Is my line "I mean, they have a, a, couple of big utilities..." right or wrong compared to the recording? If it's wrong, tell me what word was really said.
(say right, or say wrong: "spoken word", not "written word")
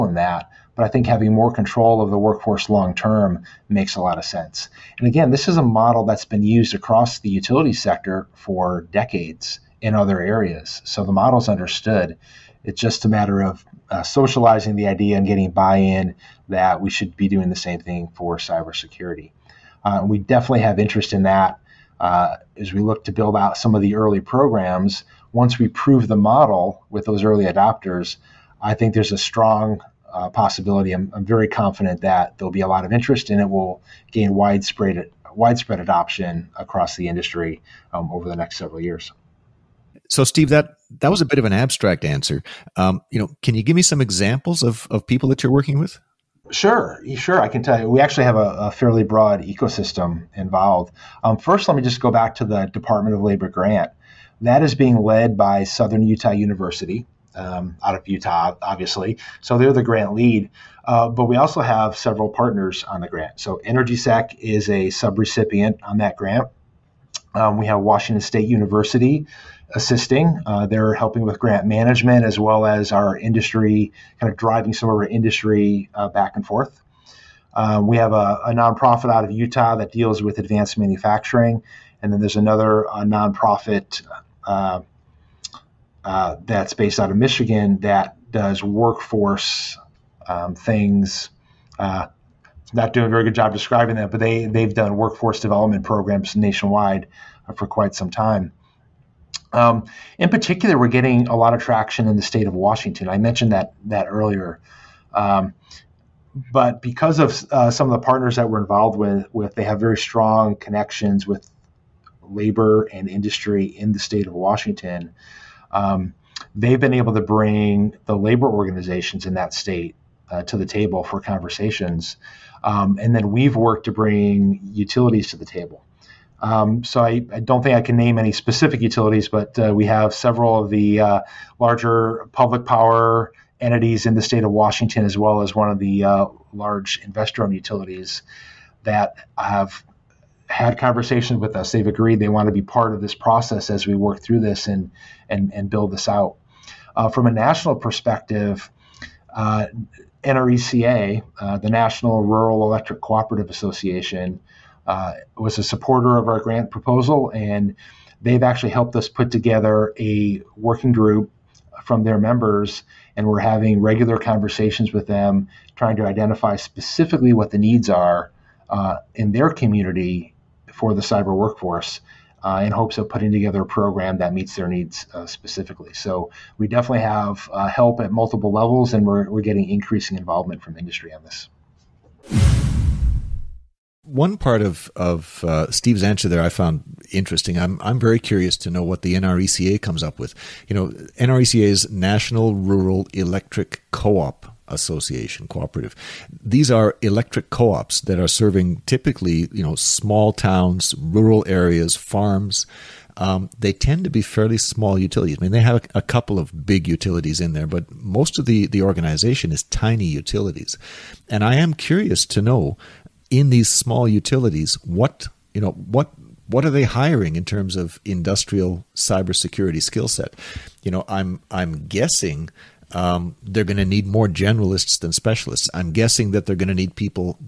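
right.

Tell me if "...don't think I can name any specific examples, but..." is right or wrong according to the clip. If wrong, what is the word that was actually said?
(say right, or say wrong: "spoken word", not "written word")
wrong: "utilities", not "examples".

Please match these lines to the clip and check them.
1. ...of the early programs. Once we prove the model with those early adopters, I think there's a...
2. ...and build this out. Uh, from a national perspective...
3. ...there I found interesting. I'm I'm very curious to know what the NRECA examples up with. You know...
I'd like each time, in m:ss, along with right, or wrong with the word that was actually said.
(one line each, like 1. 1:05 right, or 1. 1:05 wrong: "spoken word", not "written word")
1. 0:23 right
2. 2:25 right
3. 3:06 wrong: "comes", not "examples".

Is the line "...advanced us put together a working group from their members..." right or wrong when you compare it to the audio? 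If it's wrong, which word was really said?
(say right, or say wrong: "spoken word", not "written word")
wrong: "helped", not "advanced".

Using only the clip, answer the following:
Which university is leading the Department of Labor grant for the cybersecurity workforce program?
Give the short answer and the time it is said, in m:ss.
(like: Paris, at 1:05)
Southern Utah University, at 0:55.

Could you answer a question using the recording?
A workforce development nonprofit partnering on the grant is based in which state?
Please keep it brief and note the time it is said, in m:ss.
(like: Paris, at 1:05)
Michigan, at 1:27.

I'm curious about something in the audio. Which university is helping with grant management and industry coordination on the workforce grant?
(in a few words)
Washington State University.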